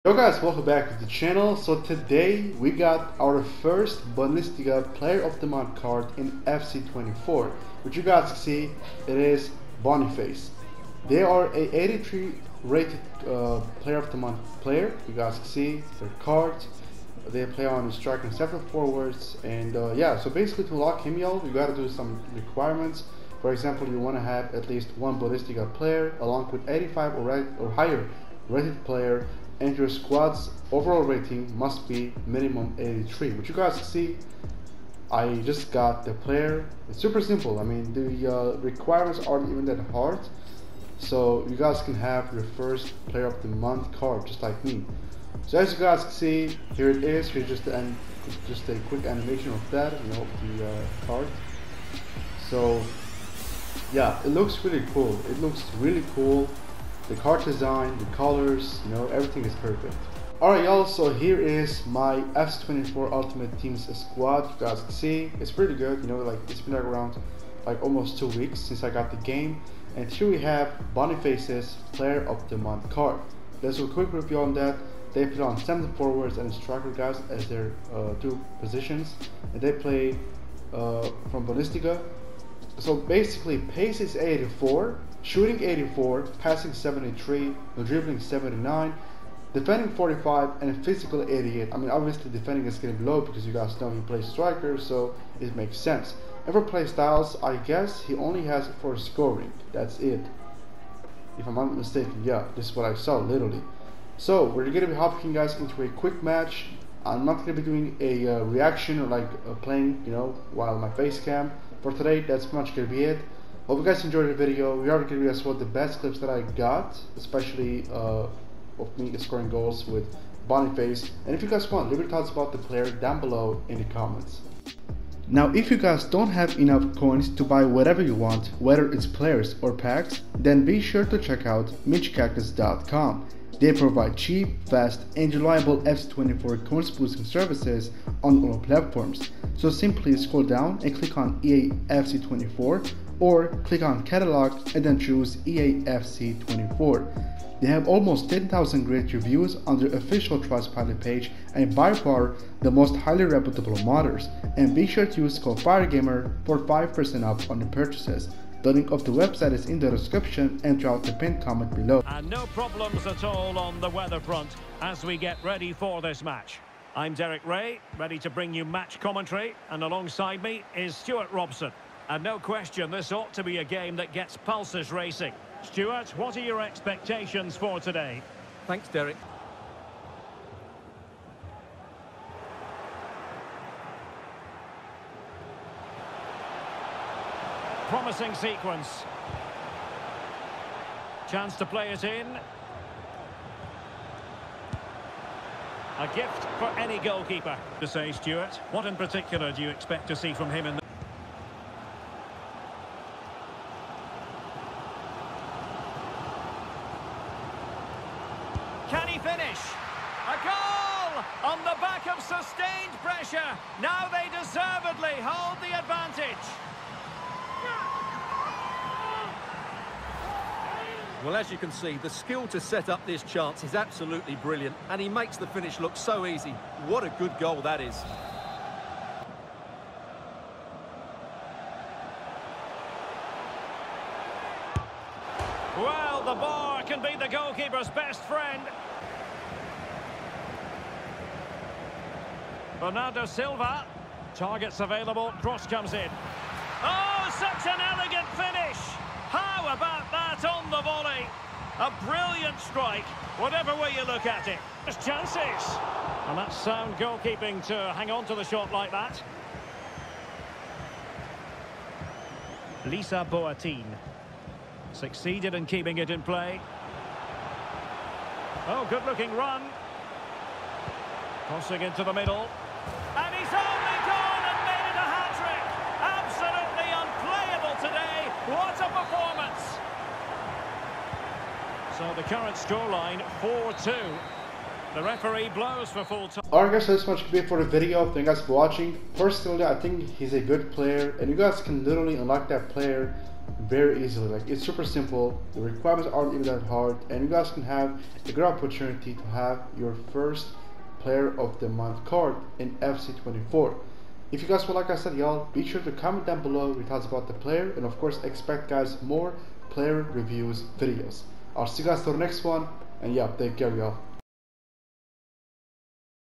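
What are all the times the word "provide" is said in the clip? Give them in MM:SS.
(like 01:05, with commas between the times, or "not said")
02:13.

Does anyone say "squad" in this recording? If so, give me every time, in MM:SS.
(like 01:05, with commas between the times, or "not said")
00:29, 01:03.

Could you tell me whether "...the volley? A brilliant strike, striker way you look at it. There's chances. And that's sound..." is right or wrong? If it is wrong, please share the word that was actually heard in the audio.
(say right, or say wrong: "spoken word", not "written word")
wrong: "whatever", not "striker".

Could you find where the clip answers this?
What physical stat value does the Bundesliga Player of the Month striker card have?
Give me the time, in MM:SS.
01:31.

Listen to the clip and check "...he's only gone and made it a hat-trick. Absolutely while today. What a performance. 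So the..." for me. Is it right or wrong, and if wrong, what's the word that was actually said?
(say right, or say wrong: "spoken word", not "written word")
wrong: "unplayable", not "while".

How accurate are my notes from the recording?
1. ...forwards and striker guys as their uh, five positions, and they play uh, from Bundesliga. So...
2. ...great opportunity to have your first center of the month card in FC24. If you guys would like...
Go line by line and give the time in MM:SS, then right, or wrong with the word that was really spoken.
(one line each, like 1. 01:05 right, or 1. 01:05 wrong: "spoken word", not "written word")
1. 01:15 wrong: "two", not "five"
2. 04:58 wrong: "player", not "center".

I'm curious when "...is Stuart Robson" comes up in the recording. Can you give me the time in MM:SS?
02:50.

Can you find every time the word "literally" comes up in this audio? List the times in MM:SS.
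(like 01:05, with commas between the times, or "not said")
01:43, 04:51.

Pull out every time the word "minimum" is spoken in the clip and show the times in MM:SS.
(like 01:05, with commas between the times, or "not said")
00:32.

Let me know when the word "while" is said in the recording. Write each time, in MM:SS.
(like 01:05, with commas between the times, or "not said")
01:50.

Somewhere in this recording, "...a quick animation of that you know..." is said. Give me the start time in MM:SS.
00:48.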